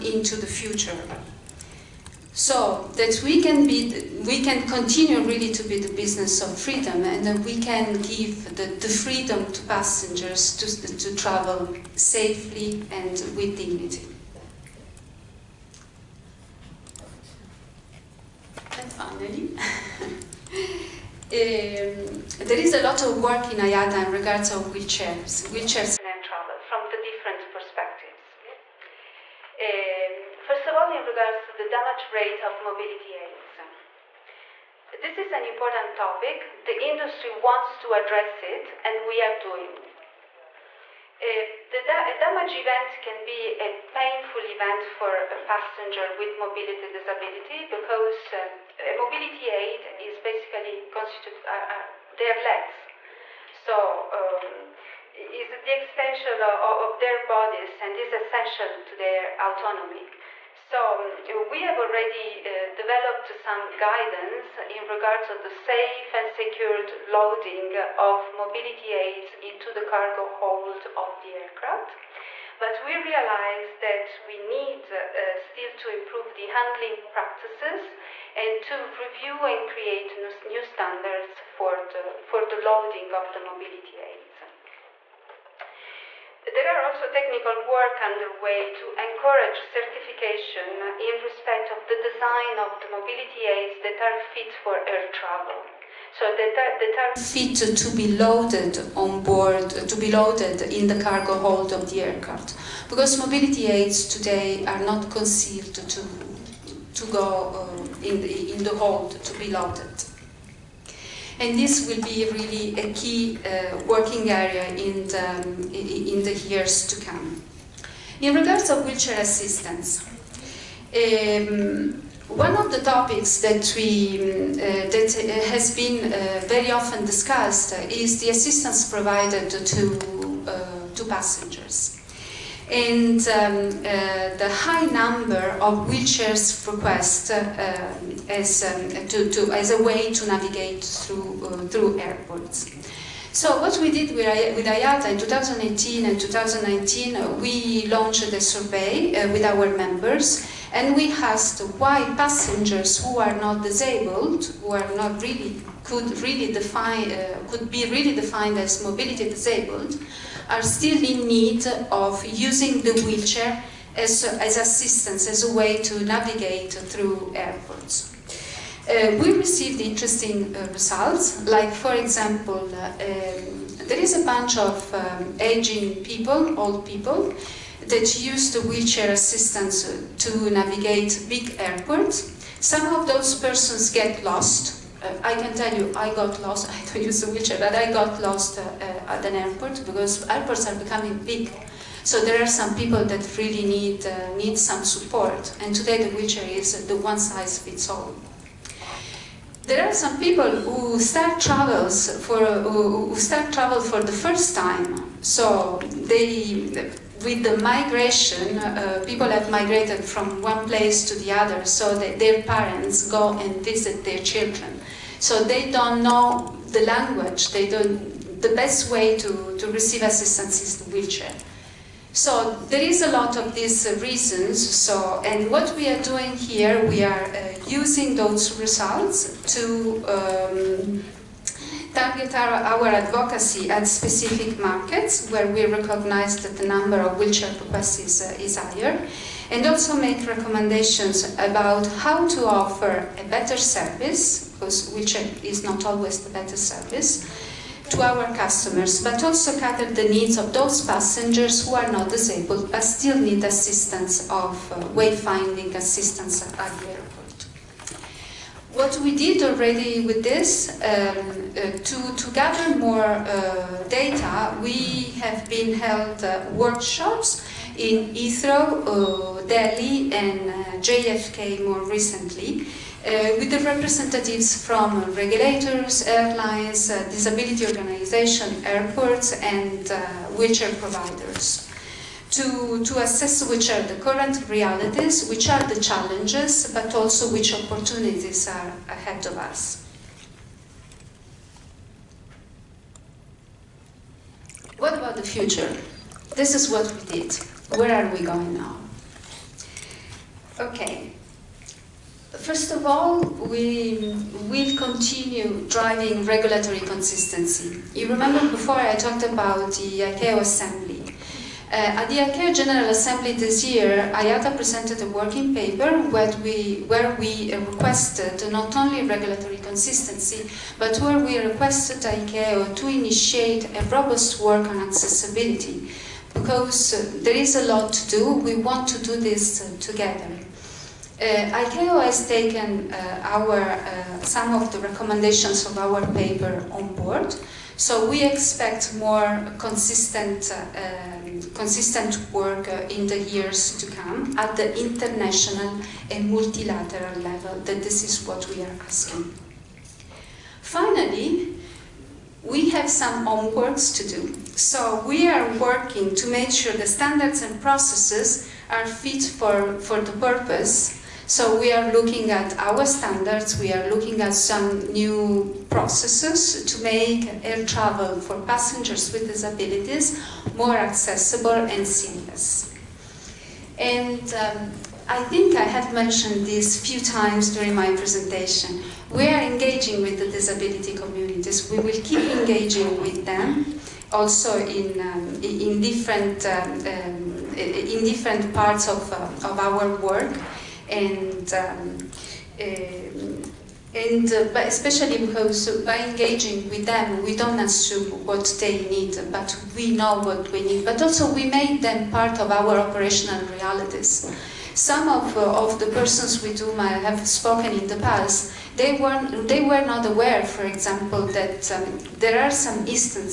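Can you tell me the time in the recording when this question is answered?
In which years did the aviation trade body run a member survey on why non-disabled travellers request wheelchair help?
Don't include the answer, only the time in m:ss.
2:25.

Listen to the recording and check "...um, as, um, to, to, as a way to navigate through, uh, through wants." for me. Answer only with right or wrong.
wrong.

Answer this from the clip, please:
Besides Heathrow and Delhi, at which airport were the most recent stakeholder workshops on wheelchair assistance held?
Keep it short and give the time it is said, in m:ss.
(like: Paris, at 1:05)
JFK, at 4:30.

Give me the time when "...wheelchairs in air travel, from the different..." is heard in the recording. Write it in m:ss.
0:25.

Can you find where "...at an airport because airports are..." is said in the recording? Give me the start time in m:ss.
3:09.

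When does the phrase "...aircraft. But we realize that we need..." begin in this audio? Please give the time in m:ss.
1:11.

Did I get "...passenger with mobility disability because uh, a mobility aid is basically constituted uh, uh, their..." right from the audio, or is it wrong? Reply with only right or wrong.
right.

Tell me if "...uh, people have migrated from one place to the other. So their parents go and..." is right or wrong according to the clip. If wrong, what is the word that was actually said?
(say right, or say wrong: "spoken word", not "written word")
right.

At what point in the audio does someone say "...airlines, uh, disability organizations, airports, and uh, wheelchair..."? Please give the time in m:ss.
4:36.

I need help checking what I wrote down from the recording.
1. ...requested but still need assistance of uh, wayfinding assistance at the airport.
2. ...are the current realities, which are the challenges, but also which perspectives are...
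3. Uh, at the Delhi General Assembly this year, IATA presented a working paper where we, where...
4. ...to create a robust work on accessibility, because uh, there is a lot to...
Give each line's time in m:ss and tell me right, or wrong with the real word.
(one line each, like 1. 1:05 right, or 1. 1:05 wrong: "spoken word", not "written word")
1. 4:12 wrong: "disabled", not "requested"
2. 4:43 wrong: "opportunities", not "perspectives"
3. 5:11 wrong: "ICAO", not "Delhi"
4. 5:22 wrong: "initiate", not "create".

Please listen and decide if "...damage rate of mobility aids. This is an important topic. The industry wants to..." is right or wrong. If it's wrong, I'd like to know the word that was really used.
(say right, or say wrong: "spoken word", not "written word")
right.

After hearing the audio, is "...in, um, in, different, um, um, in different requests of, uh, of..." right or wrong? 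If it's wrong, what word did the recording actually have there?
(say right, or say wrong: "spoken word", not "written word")
wrong: "parts", not "requests".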